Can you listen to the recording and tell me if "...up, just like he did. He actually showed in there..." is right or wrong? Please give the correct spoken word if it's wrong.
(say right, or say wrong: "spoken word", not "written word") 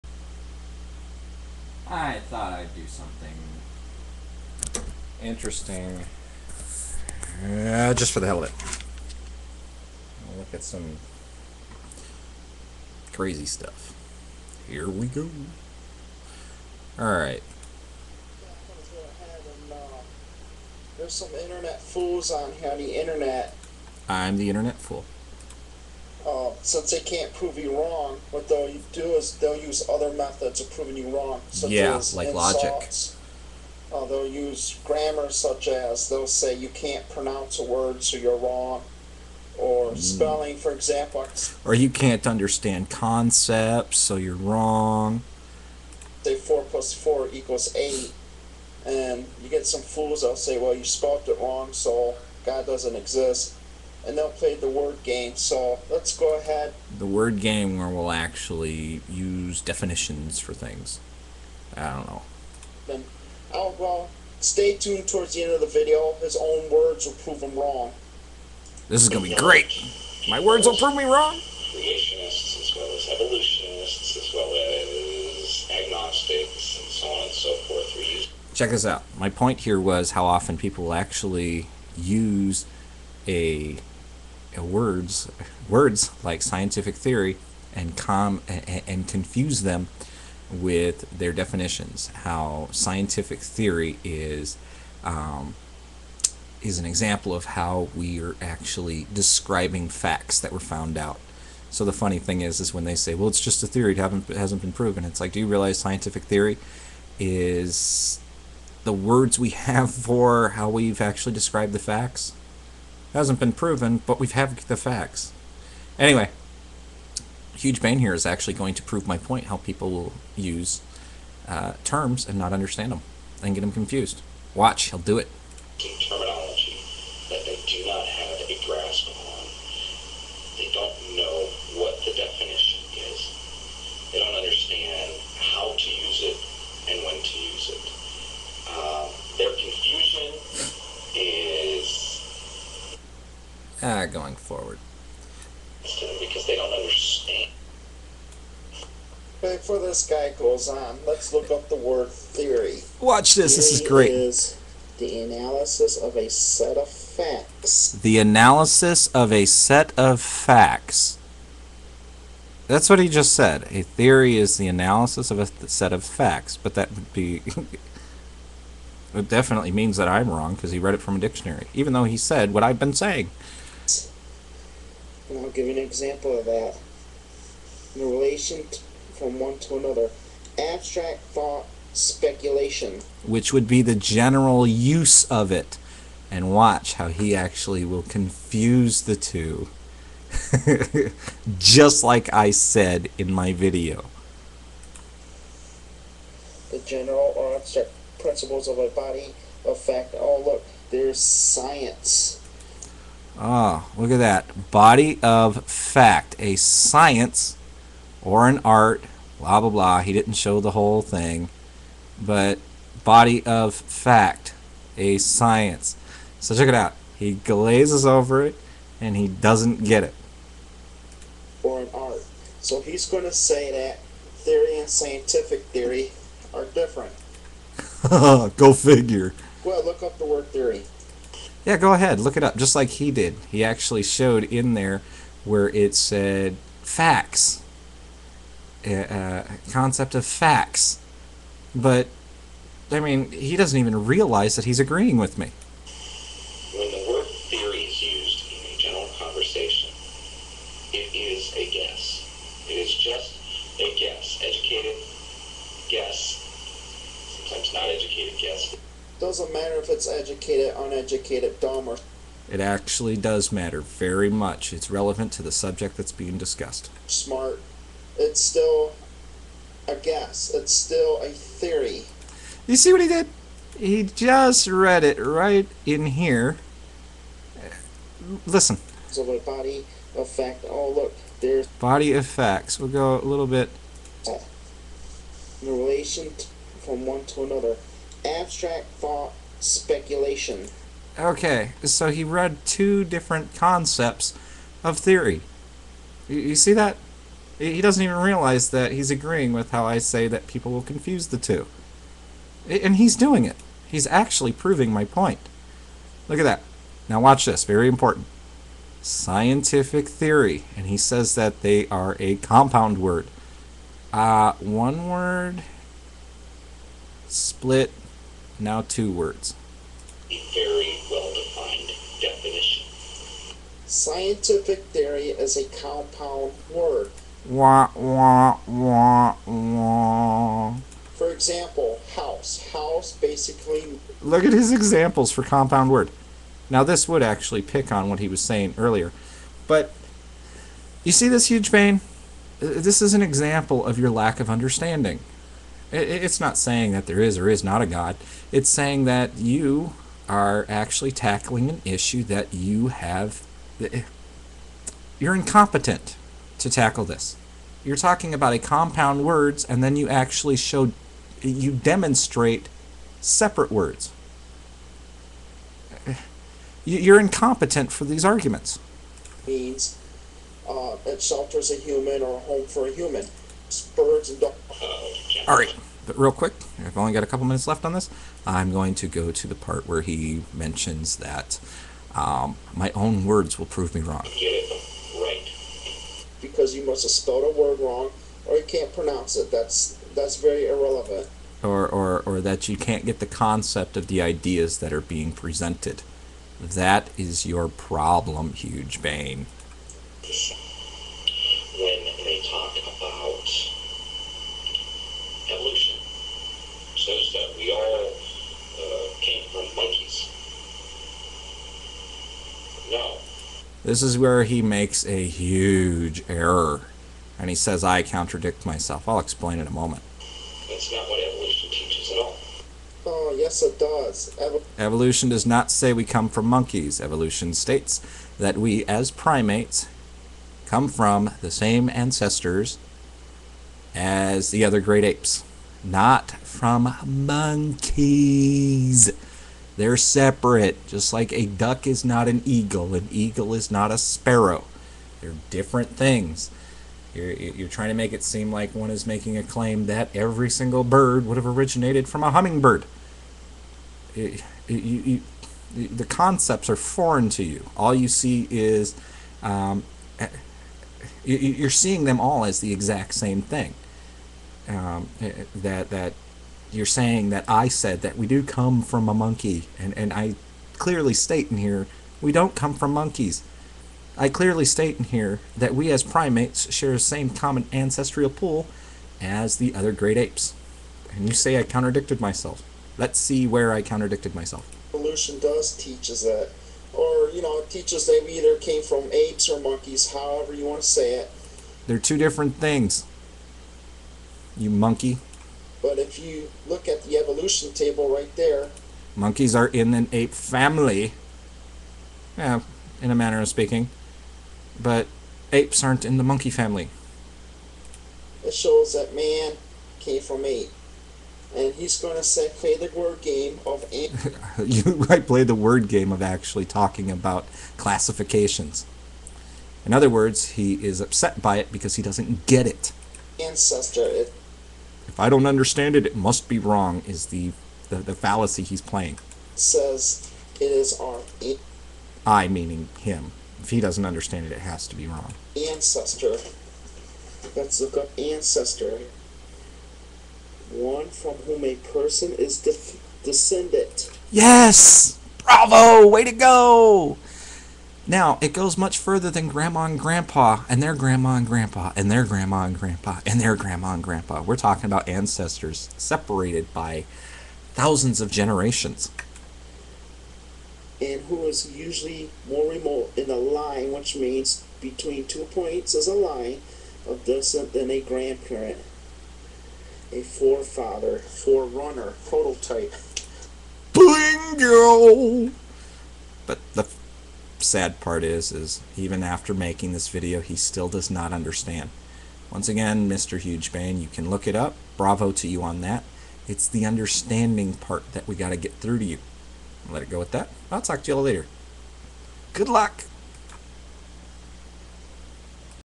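right.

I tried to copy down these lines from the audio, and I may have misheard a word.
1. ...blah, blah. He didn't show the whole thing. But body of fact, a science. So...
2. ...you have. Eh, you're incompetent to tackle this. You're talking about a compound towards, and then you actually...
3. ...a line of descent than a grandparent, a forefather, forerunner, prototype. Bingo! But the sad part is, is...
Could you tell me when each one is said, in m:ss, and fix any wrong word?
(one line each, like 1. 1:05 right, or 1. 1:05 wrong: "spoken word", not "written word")
1. 3:29 right
2. 5:52 wrong: "words", not "towards"
3. 9:26 right.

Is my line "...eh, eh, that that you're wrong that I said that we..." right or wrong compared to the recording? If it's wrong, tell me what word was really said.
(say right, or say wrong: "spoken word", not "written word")
wrong: "saying", not "wrong".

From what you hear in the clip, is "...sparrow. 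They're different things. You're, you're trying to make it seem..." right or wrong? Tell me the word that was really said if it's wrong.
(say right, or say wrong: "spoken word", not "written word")
right.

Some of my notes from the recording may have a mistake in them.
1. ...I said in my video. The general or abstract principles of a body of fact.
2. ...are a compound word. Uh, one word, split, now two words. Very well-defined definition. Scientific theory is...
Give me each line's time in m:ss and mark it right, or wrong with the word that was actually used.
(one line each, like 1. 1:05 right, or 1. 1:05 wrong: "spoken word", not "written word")
1. 3:12 right
2. 5:11 right.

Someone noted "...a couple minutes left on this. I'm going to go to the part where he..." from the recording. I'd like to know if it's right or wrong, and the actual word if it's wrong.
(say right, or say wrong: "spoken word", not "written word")
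right.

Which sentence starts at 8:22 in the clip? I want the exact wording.
Yeah, in a manner of speaking.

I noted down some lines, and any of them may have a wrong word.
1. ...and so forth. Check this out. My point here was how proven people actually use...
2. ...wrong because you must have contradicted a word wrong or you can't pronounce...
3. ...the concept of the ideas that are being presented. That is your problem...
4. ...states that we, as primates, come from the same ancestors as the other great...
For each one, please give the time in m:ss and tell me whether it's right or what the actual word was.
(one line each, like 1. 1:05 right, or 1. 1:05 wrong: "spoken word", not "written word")
1. 1:17 wrong: "often", not "proven"
2. 6:24 wrong: "spelled", not "contradicted"
3. 6:33 right
4. 7:07 right.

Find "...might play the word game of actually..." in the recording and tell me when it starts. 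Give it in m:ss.
8:35.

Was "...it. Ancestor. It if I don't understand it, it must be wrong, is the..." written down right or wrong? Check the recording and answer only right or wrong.
right.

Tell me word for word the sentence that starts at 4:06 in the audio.
When the word theory is used in a general conversation, it is a guess.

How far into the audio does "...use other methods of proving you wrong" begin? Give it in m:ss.
0:29.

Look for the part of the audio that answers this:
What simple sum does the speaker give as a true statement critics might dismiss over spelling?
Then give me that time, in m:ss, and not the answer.
0:46.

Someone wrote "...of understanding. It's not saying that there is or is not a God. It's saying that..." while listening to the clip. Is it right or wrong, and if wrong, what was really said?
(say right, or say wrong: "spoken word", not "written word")
right.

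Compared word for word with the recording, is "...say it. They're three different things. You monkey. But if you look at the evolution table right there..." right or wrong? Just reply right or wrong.
wrong.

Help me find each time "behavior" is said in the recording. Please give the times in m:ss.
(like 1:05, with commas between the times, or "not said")
not said.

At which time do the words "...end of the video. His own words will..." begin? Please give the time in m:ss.
1:05.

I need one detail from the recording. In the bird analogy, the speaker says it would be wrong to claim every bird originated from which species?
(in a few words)
hummingbird.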